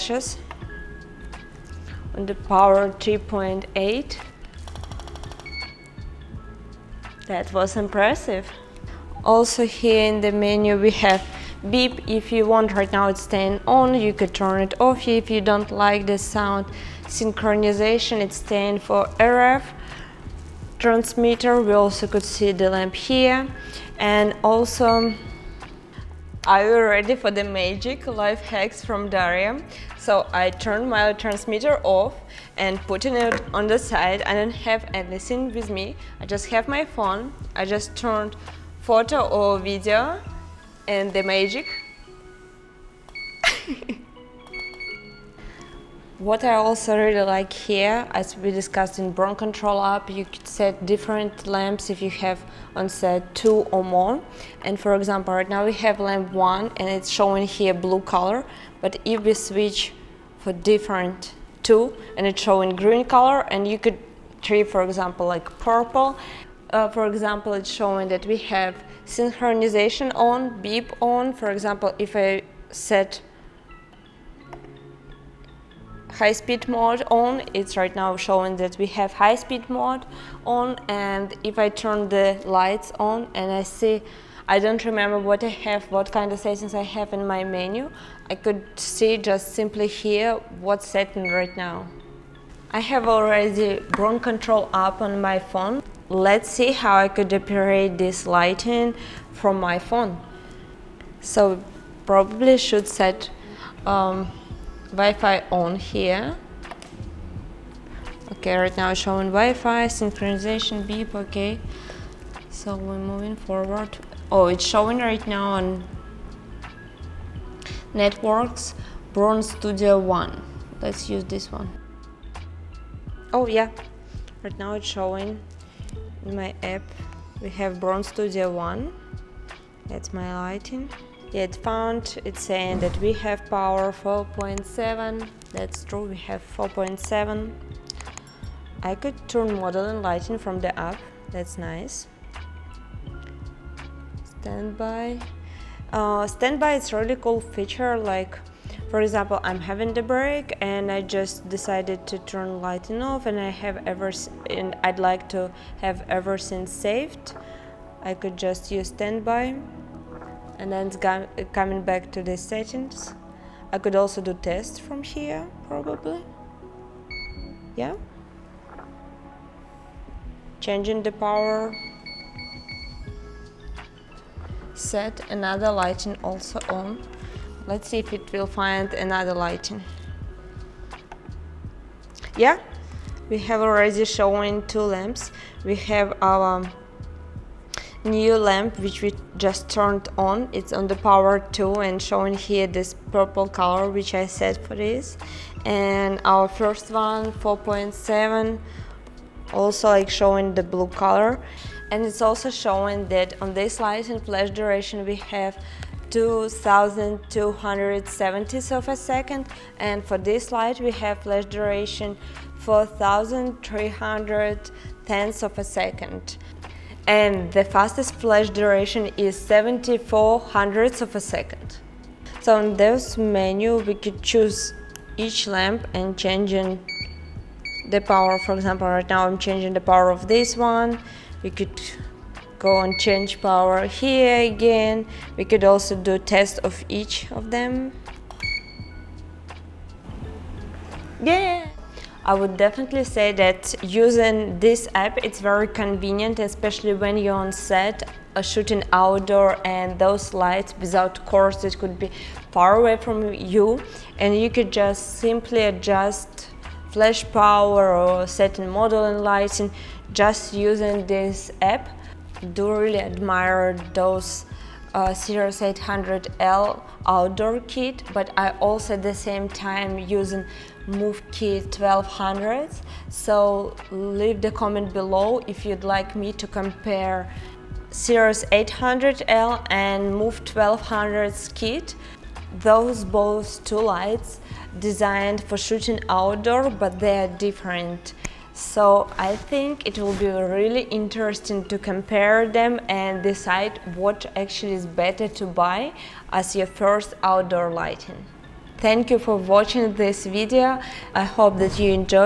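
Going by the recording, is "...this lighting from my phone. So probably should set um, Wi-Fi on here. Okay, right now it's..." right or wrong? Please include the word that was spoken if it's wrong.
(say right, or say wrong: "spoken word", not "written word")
right.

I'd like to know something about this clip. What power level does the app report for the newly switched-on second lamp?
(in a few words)
2.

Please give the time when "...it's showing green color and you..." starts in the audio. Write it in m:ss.
1:02.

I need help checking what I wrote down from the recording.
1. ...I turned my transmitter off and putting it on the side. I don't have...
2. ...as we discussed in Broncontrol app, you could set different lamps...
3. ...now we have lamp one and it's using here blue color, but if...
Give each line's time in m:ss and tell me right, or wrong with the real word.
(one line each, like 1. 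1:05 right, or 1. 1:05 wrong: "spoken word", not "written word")
1. 0:30 right
2. 0:48 right
3. 0:55 wrong: "showing", not "using".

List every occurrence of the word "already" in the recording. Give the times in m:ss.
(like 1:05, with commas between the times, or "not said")
1:33, 3:03.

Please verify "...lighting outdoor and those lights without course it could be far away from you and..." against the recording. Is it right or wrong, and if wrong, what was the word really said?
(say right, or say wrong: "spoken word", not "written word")
wrong: "shooting", not "lighting".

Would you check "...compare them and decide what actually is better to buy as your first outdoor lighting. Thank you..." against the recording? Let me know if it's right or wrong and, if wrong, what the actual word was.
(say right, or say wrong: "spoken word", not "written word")
right.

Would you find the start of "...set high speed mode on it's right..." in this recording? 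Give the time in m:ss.
1:12.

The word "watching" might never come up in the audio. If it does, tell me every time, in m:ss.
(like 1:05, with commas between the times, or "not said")
4:59.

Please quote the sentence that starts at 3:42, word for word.
So in this menu we could choose each lamp and changing the power.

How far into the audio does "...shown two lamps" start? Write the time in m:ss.
3:04.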